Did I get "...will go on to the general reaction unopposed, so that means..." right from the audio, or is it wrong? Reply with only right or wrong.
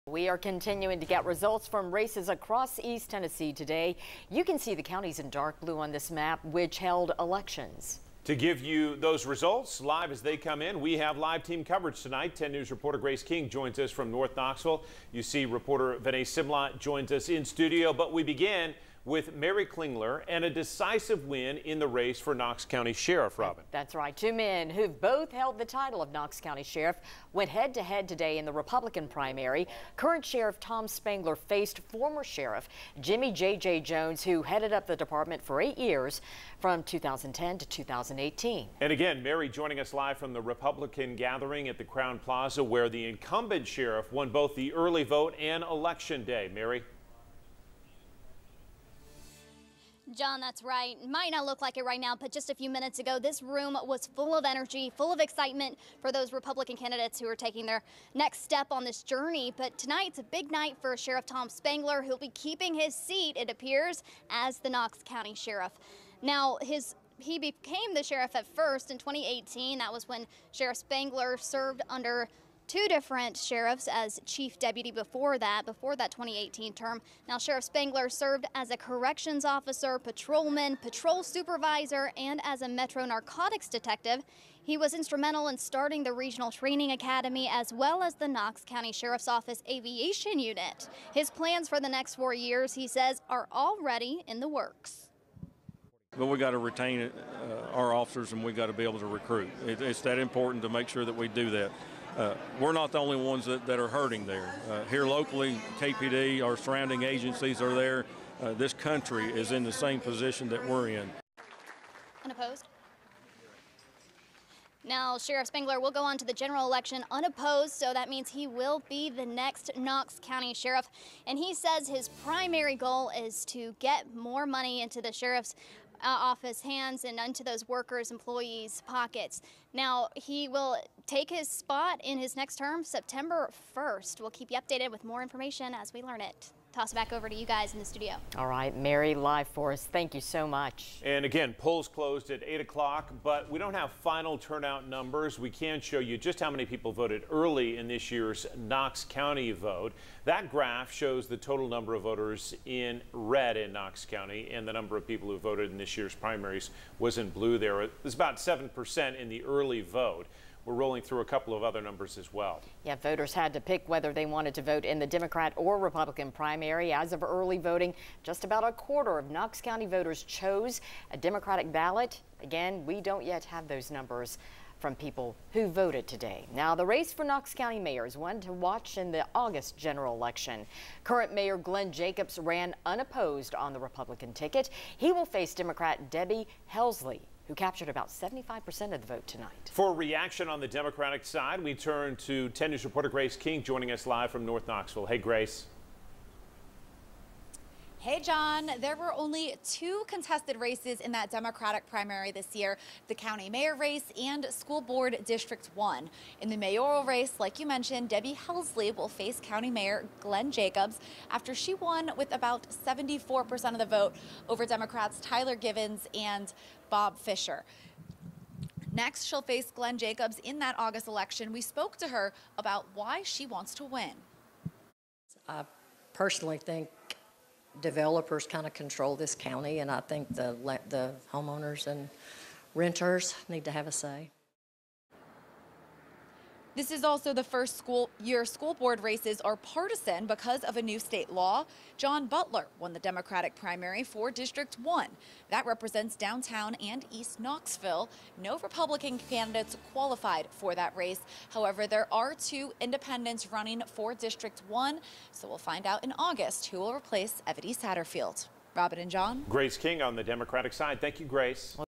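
wrong.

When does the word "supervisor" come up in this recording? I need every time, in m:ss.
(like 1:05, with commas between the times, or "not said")
1:21.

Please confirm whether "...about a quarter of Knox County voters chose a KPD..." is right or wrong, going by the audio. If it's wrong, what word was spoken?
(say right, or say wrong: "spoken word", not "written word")
wrong: "Democratic", not "KPD".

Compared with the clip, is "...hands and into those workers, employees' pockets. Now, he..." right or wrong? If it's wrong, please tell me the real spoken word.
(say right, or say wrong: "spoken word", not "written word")
right.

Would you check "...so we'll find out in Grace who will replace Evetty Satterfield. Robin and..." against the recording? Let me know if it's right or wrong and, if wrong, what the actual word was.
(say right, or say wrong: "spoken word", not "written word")
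wrong: "August", not "Grace".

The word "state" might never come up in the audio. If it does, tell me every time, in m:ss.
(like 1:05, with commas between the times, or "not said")
4:00.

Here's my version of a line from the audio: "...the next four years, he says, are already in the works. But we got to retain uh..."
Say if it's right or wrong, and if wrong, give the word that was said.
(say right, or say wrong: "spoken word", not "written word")
right.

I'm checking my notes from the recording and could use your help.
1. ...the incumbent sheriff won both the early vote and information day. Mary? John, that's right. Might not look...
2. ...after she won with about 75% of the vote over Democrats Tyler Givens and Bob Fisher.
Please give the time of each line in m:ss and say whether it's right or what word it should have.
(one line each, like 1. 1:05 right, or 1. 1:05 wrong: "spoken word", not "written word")
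1. 0:42 wrong: "election", not "information"
2. 3:31 wrong: "74", not "75".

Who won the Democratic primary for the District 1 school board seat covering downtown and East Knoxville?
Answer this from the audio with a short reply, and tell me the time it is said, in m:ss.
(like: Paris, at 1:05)
John Butler, at 4:01.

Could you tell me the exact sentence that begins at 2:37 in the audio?
It was about 7% in the early vote.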